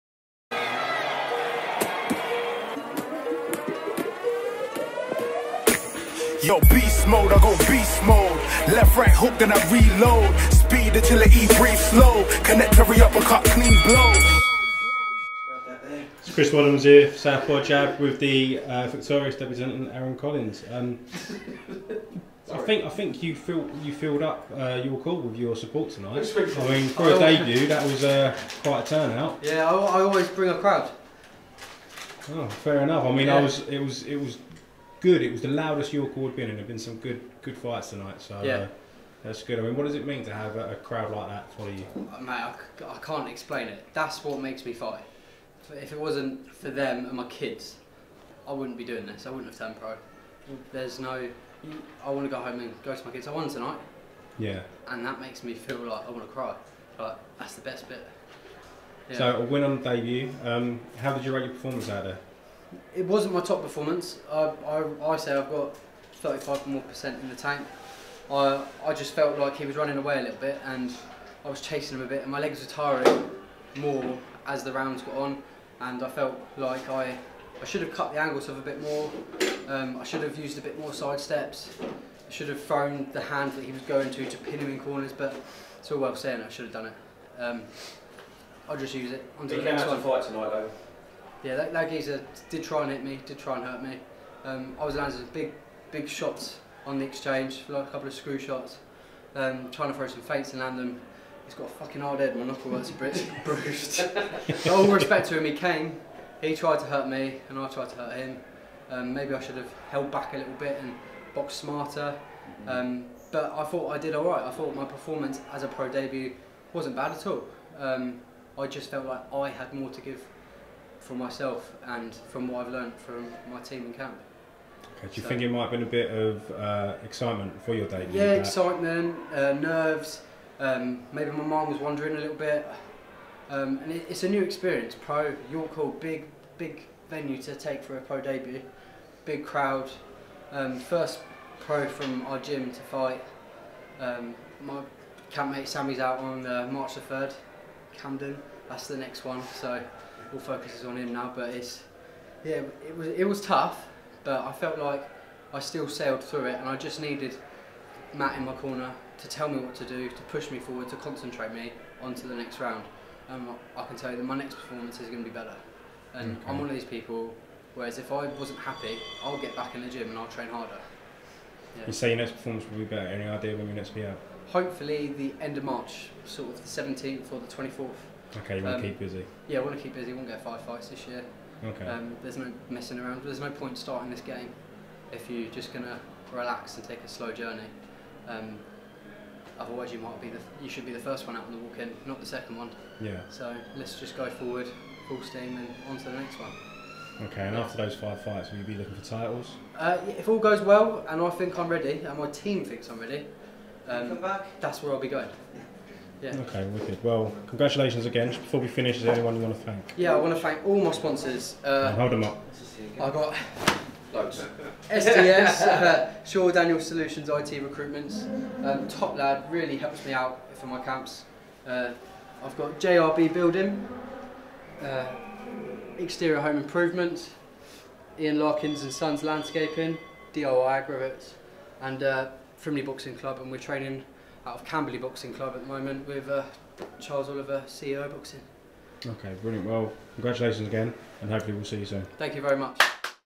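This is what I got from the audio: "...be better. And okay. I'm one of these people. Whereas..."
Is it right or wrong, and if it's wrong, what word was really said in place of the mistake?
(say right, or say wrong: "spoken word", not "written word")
right.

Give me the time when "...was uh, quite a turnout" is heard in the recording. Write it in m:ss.
0:27.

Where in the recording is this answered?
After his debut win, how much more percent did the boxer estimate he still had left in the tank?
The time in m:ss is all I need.
1:06.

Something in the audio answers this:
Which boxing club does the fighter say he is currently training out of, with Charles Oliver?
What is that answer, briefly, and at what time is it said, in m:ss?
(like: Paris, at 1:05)
Camberley Boxing Club, at 3:54.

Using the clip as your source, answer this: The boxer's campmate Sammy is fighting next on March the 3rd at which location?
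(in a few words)
Camden.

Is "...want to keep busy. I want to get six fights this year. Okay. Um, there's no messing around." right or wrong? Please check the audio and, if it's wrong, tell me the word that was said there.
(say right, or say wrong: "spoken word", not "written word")
wrong: "five", not "six".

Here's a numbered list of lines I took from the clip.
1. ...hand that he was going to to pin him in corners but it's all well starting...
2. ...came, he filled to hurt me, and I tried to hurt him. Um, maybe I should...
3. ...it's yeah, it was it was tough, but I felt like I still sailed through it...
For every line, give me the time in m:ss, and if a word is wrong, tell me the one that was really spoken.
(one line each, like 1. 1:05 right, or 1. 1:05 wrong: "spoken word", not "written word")
1. 1:23 wrong: "saying", not "starting"
2. 1:45 wrong: "tried", not "filled"
3. 2:31 right.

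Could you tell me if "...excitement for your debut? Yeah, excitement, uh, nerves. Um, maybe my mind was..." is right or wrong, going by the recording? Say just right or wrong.
right.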